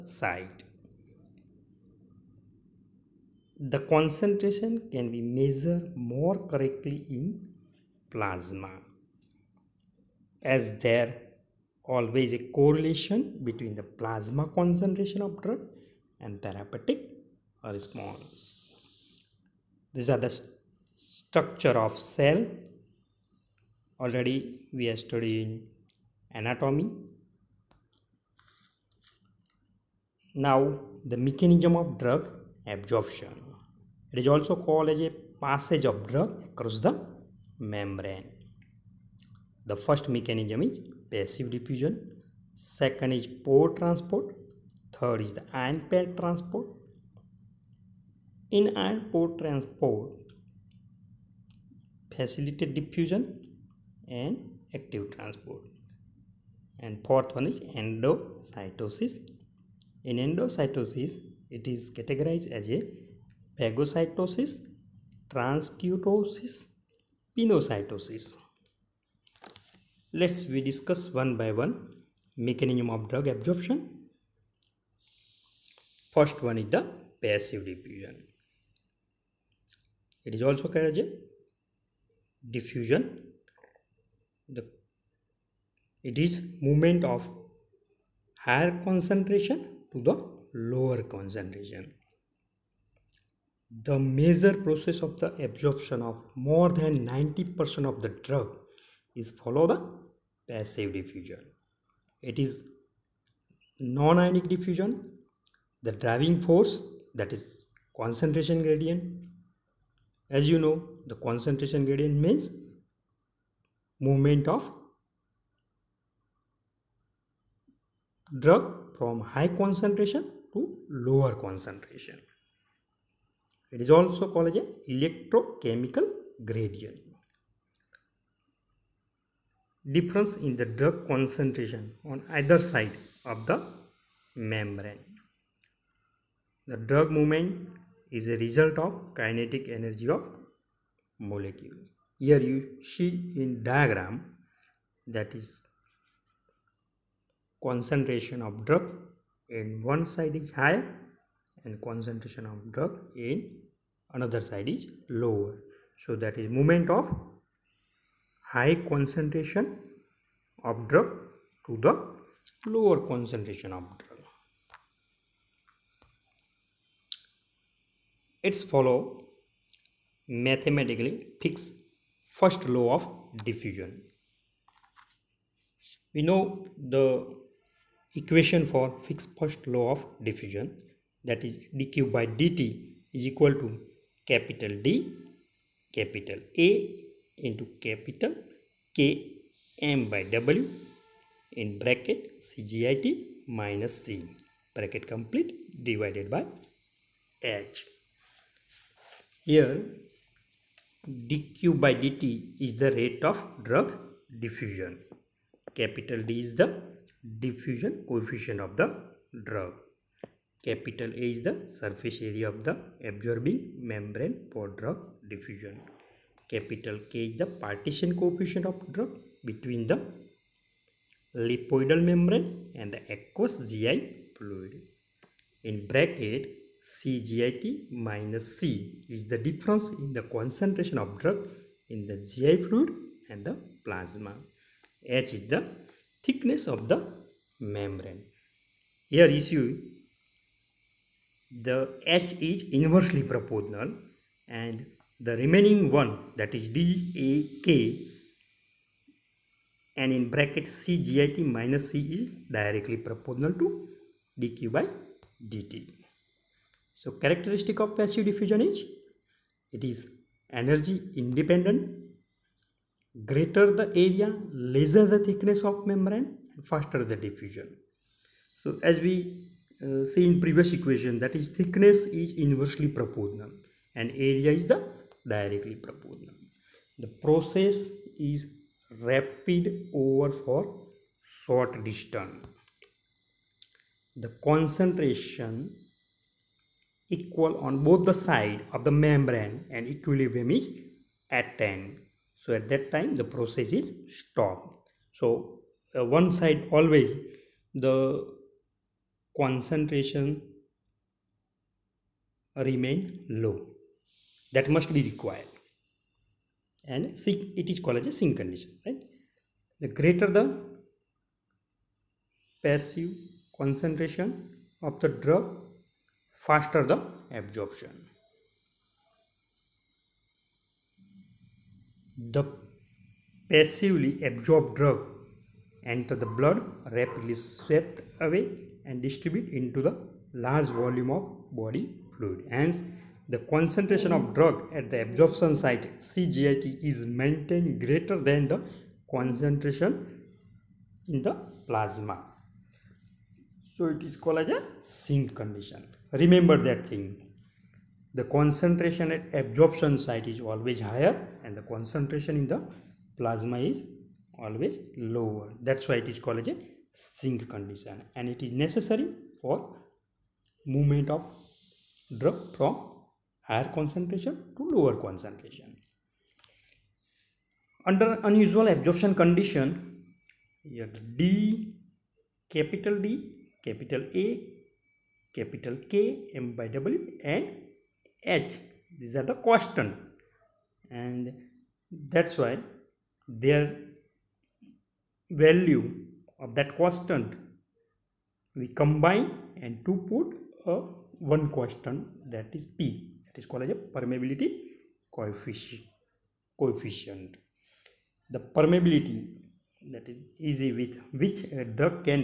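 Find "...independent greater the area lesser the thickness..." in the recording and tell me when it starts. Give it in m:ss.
4:21.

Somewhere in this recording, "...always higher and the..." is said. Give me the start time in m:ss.
5:50.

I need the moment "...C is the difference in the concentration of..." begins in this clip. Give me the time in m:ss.
3:48.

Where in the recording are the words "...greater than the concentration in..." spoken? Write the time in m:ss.
5:37.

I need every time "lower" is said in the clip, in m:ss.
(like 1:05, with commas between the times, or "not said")
1:30, 2:01, 2:35, 2:42, 5:54, 6:04.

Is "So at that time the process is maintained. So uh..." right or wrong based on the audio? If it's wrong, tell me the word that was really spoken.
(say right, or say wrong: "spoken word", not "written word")
wrong: "stopped", not "maintained".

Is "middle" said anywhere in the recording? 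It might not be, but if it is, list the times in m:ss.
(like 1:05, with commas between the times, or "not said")
not said.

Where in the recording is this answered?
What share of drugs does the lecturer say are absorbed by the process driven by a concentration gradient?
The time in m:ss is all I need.
1:36.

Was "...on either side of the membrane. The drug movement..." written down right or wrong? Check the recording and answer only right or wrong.
right.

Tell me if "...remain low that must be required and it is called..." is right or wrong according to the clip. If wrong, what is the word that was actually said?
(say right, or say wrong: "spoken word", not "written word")
right.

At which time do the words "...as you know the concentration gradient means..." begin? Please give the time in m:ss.
1:50.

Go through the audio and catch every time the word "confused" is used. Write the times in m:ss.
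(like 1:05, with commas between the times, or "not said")
not said.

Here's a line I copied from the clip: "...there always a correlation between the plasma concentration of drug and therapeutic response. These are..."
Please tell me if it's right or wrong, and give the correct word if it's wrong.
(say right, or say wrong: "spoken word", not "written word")
right.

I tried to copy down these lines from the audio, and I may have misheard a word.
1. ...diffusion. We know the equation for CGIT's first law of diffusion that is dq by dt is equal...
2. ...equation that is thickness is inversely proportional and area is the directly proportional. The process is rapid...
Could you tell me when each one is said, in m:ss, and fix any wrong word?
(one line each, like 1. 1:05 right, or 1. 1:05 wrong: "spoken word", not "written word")
1. 2:53 wrong: "Fick", not "CGIT"
2. 4:30 right.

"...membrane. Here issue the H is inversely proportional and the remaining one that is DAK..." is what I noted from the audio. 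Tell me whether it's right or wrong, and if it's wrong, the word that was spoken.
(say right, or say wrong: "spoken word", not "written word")
right.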